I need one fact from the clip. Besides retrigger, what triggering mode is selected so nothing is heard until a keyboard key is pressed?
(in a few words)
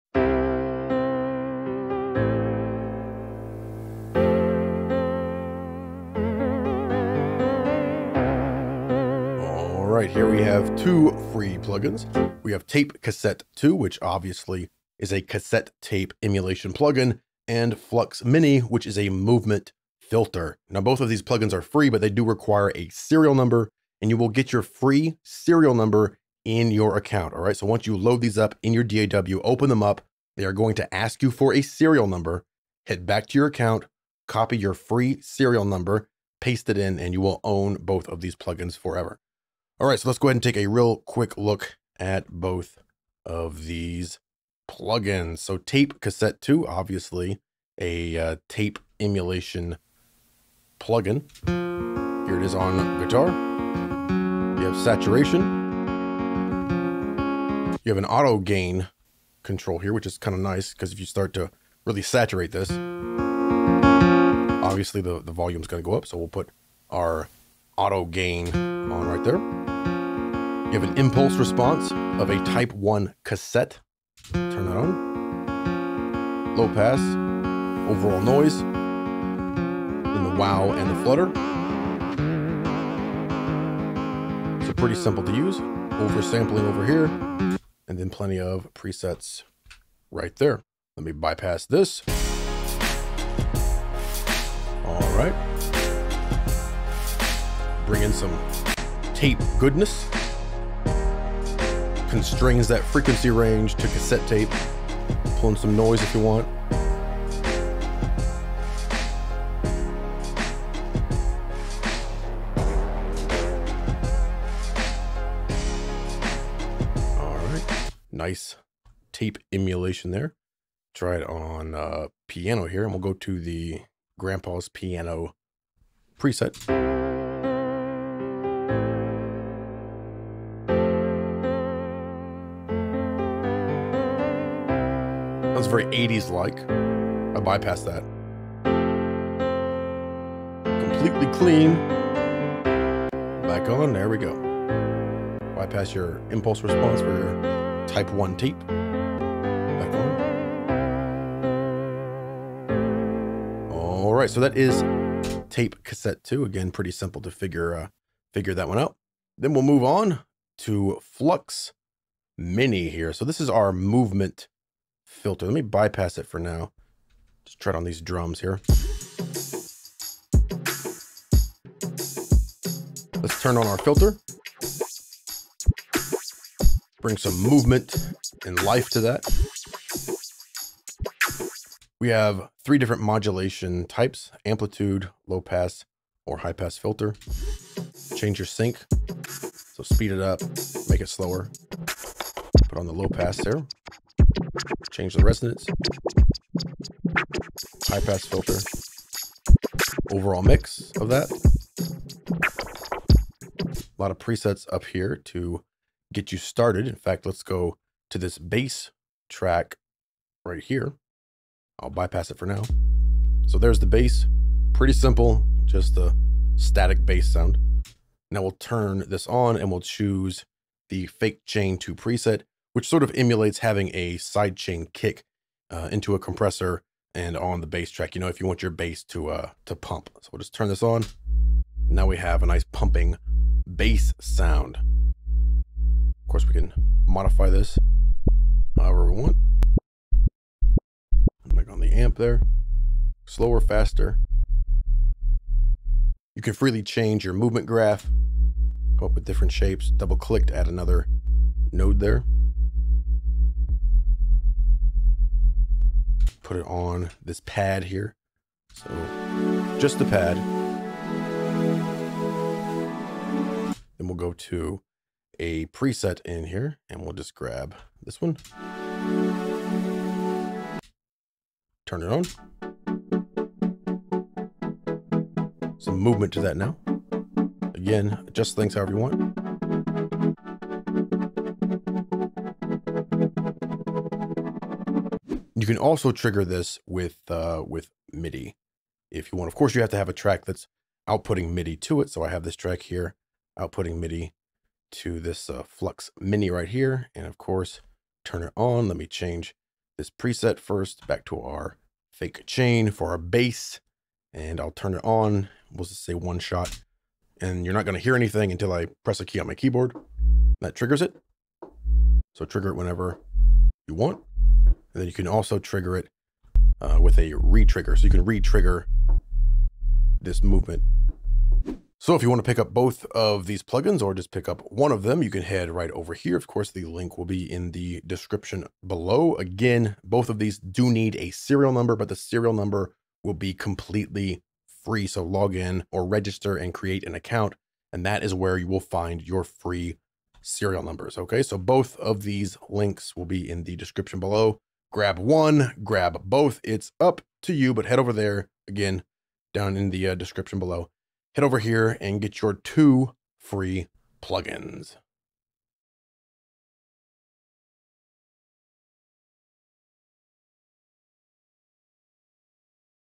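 one shot.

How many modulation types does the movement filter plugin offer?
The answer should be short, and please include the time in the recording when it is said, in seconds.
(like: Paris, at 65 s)
3, at 182 s.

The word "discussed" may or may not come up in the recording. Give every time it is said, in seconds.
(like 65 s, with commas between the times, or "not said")
not said.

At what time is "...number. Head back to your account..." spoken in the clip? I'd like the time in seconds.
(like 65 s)
32 s.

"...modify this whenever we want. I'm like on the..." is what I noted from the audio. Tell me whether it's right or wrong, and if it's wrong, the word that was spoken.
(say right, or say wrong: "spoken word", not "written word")
wrong: "however", not "whenever".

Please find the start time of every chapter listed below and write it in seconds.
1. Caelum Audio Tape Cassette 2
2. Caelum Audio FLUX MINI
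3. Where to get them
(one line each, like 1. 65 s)
1. 45 s
2. 160 s
3. 322 s.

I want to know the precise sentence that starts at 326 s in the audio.
Of course, the link will be in the description below.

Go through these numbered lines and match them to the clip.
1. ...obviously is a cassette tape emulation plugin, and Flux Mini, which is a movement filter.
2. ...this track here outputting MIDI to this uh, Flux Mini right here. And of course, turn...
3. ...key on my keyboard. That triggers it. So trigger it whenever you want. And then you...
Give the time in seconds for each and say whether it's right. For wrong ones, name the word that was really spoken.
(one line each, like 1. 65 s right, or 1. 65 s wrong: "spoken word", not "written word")
1. 14 s right
2. 292 s right
3. 309 s right.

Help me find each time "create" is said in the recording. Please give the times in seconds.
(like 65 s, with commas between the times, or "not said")
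336 s.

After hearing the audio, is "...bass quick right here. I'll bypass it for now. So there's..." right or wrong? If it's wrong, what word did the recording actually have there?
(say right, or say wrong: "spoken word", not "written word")
wrong: "track", not "quick".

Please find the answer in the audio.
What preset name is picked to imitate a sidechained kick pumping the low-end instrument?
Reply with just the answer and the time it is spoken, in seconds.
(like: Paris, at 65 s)
fake chain 2, at 221 s.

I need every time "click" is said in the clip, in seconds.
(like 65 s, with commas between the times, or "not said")
250 s.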